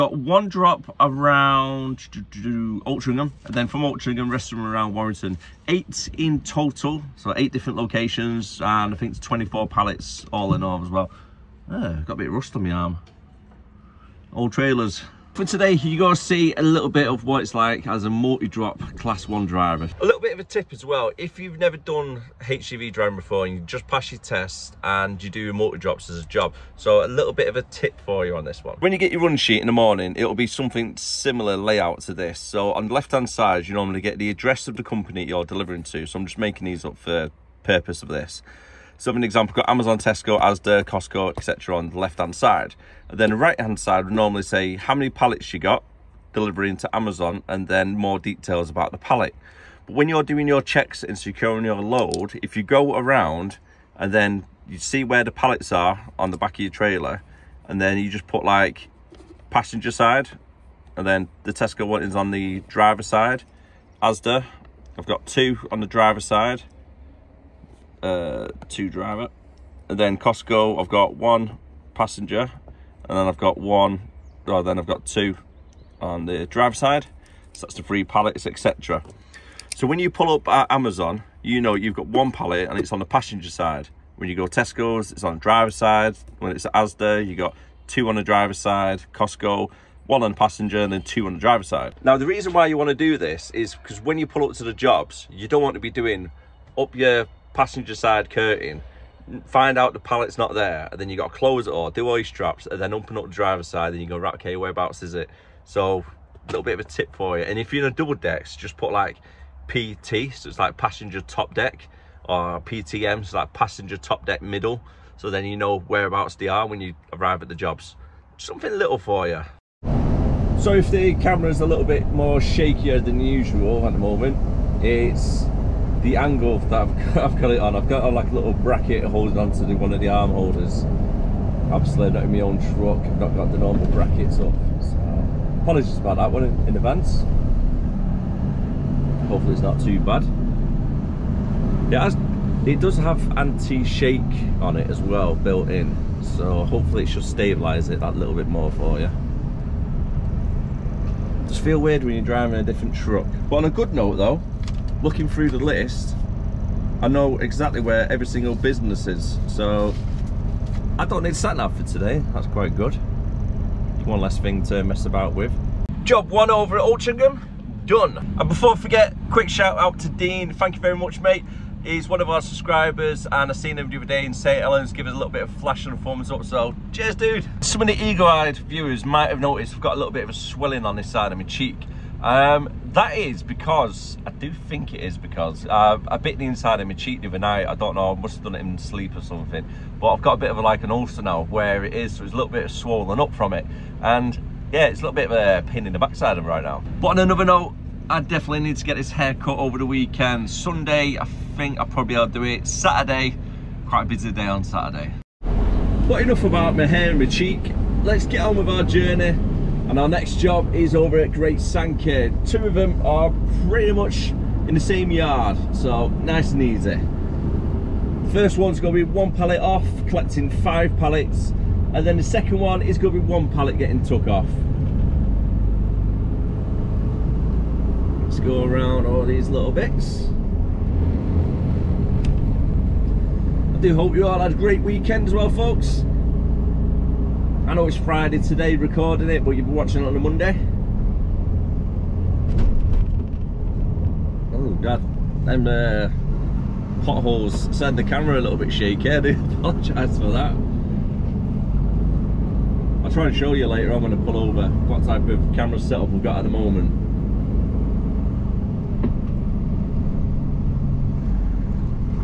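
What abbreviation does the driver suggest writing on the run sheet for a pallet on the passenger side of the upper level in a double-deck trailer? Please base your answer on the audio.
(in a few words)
PT.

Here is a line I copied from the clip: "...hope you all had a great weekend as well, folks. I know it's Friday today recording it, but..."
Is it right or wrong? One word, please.
right.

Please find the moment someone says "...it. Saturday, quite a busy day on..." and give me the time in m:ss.
3:22.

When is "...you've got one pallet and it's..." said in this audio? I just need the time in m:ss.
1:21.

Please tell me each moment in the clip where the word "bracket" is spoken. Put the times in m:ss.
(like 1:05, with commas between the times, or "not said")
2:08, 2:13.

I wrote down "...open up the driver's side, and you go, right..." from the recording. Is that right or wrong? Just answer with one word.
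right.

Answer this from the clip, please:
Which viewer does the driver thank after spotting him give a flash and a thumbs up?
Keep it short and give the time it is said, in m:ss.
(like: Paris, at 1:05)
Dean, at 2:50.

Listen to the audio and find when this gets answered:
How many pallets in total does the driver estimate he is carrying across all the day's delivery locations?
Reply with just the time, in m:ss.
0:09.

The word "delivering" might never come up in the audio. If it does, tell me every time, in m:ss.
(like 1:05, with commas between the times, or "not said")
0:35, 0:46.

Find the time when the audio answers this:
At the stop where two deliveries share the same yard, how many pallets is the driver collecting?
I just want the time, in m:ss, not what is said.
3:40.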